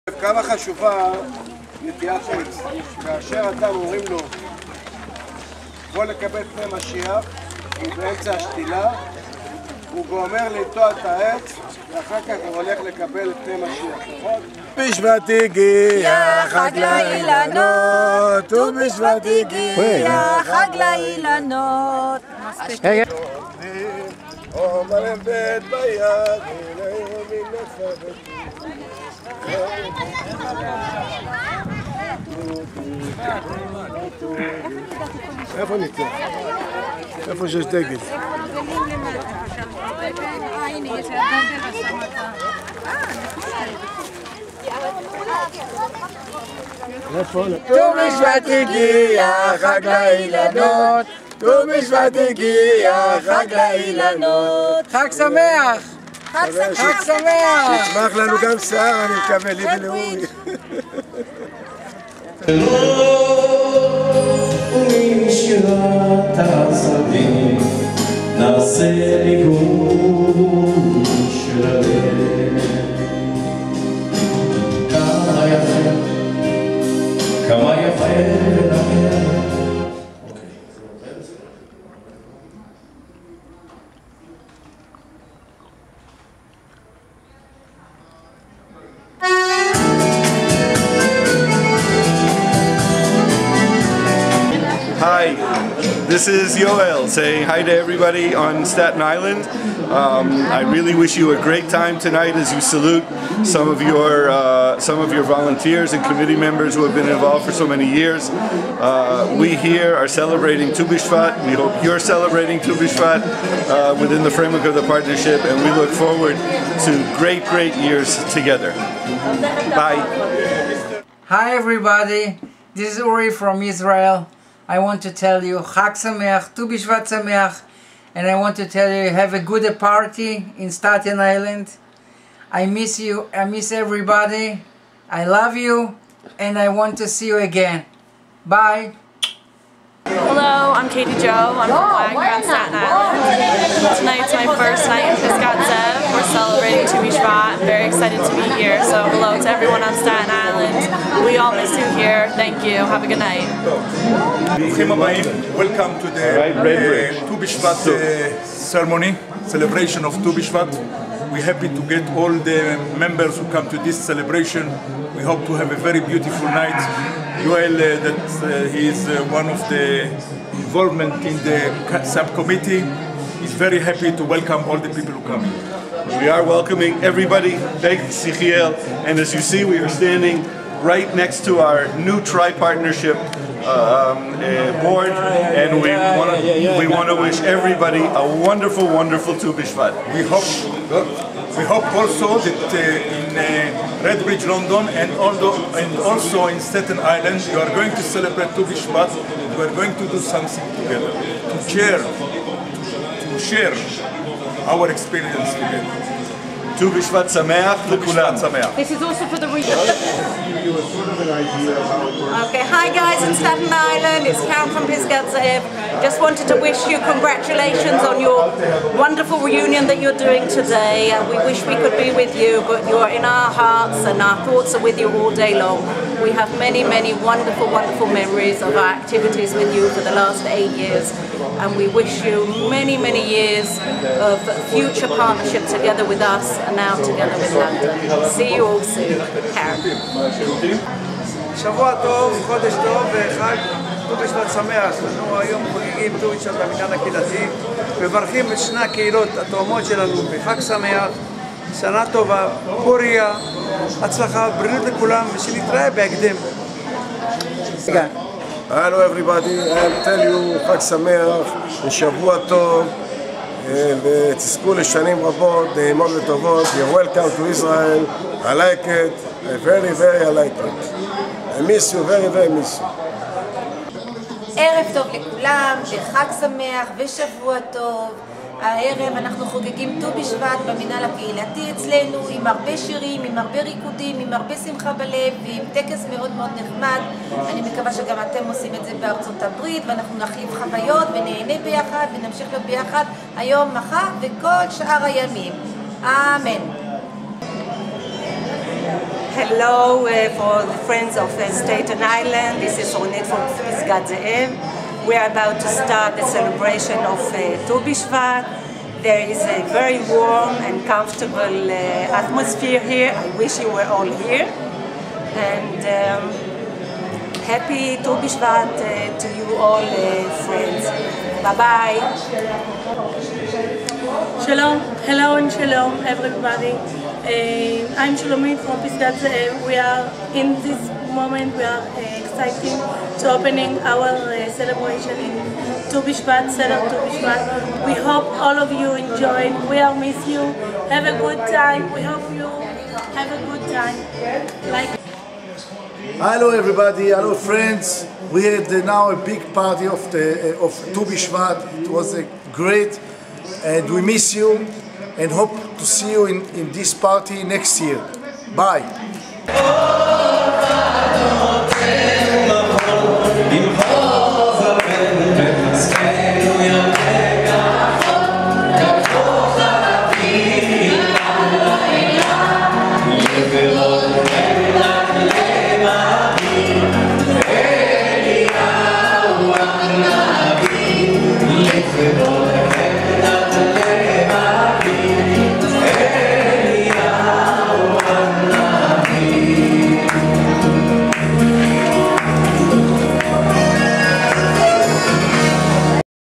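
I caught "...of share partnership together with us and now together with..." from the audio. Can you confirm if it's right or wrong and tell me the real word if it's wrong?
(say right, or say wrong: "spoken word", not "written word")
wrong: "future", not "share".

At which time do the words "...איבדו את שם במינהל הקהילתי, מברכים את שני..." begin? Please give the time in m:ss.
4:06.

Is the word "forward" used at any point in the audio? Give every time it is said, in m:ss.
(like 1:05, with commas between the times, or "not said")
1:55.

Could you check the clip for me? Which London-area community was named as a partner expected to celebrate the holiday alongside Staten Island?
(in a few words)
Redbridge.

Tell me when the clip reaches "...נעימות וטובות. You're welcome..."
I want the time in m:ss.
4:25.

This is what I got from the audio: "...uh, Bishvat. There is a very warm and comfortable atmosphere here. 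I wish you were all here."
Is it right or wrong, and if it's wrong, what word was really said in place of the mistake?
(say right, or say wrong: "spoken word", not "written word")
right.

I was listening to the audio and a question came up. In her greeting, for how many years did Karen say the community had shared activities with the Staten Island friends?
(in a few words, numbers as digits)
8.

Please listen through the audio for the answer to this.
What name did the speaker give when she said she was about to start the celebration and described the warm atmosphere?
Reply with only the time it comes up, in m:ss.
5:02.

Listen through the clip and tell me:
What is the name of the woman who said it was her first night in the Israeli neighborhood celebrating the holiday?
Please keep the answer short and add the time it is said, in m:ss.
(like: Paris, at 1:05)
Katie Joe, at 2:20.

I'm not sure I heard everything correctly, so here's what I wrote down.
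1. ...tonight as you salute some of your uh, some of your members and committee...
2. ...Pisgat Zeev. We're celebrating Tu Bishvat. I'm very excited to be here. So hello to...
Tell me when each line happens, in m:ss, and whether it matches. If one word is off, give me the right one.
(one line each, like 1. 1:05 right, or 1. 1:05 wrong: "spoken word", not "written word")
1. 1:41 wrong: "volunteers", not "members"
2. 2:25 right.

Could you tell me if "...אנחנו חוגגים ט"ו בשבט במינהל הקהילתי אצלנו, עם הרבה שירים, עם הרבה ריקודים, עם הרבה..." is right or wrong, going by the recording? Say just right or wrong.
right.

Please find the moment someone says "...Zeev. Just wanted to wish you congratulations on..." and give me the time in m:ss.
3:35.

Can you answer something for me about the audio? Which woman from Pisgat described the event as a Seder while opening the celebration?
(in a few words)
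Shulamit.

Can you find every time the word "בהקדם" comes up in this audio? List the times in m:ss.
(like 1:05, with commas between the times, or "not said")
4:15.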